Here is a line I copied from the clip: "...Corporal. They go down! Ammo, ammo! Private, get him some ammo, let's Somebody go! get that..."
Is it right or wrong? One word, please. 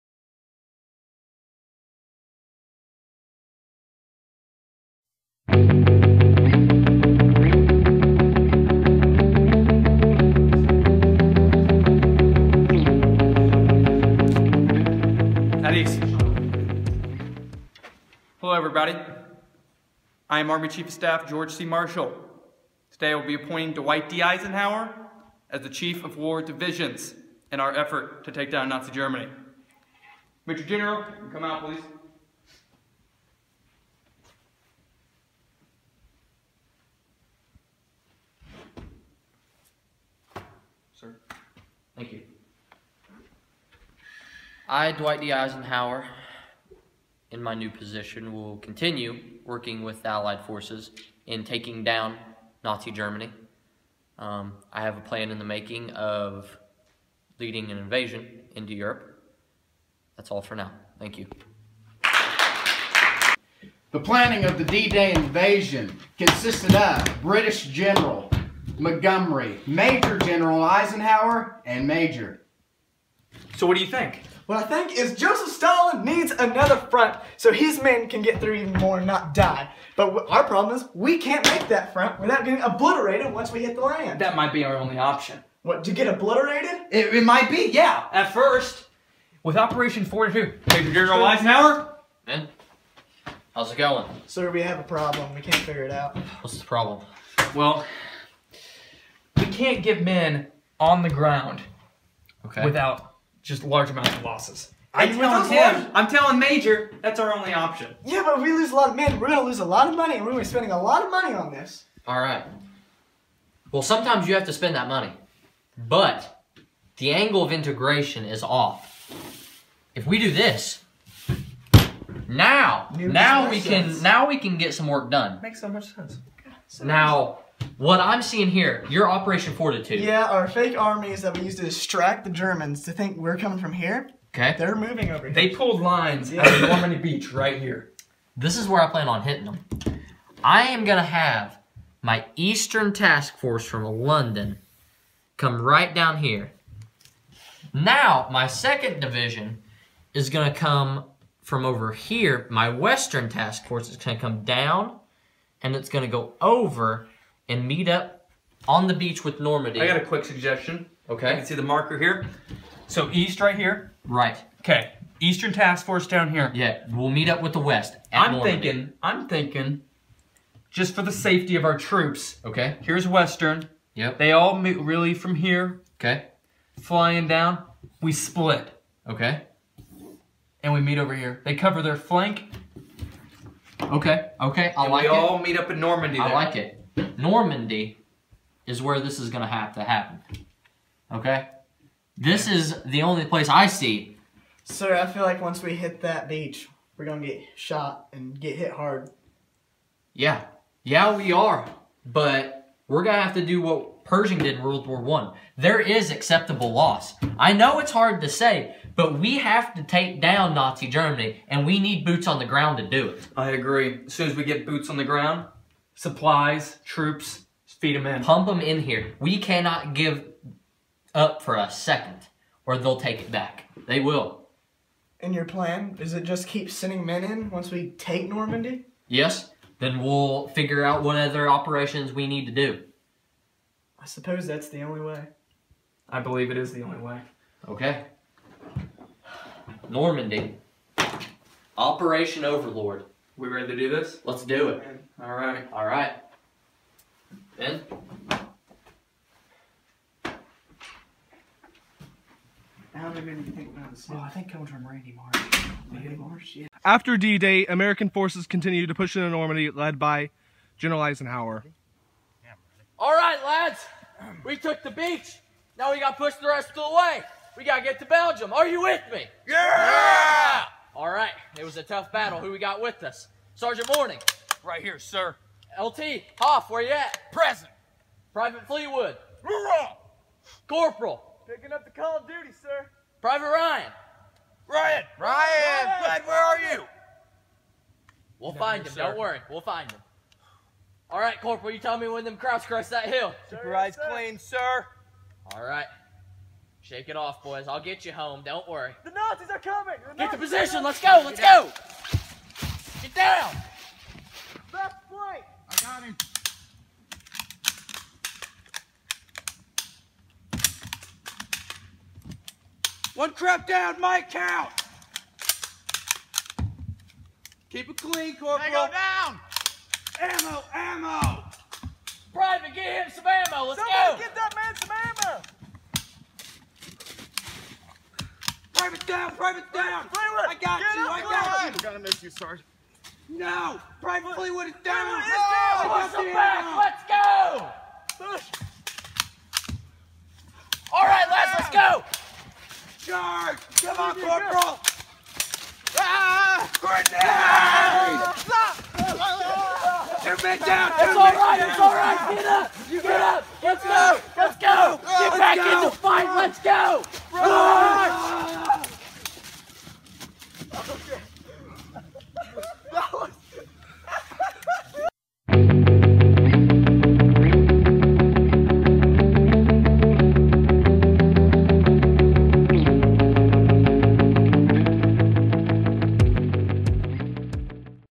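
right.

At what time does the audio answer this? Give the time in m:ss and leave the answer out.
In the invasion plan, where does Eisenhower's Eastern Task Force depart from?
2:24.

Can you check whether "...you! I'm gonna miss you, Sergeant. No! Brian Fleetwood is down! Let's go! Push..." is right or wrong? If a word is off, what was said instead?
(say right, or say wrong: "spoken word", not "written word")
right.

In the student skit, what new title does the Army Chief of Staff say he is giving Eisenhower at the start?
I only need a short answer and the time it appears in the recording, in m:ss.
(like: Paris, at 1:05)
Chief of War Divisions, at 0:25.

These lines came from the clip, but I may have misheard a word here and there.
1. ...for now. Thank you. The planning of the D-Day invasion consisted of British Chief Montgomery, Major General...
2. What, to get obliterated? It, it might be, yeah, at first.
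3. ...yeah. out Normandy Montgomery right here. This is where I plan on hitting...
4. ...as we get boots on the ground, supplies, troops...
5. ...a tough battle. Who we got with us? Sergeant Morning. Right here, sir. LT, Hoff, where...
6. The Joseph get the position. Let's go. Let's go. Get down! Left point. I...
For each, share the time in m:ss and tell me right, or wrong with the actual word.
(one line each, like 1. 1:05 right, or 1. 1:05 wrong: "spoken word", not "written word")
1. 1:00 wrong: "General", not "Chief"
2. 1:25 right
3. 2:16 wrong: "Beach", not "Montgomery"
4. 3:34 right
5. 4:31 right
6. 4:59 wrong: "Nazis", not "Joseph".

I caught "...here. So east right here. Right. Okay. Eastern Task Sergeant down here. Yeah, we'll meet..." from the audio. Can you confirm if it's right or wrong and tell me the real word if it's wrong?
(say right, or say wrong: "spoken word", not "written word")
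wrong: "Force", not "Sergeant".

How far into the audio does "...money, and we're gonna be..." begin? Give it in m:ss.
1:49.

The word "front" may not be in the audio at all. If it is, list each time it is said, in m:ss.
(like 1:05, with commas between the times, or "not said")
1:16, 1:21.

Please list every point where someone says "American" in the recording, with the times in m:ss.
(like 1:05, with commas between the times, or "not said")
4:17.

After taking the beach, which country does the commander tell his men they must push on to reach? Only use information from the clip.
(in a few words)
Belgium.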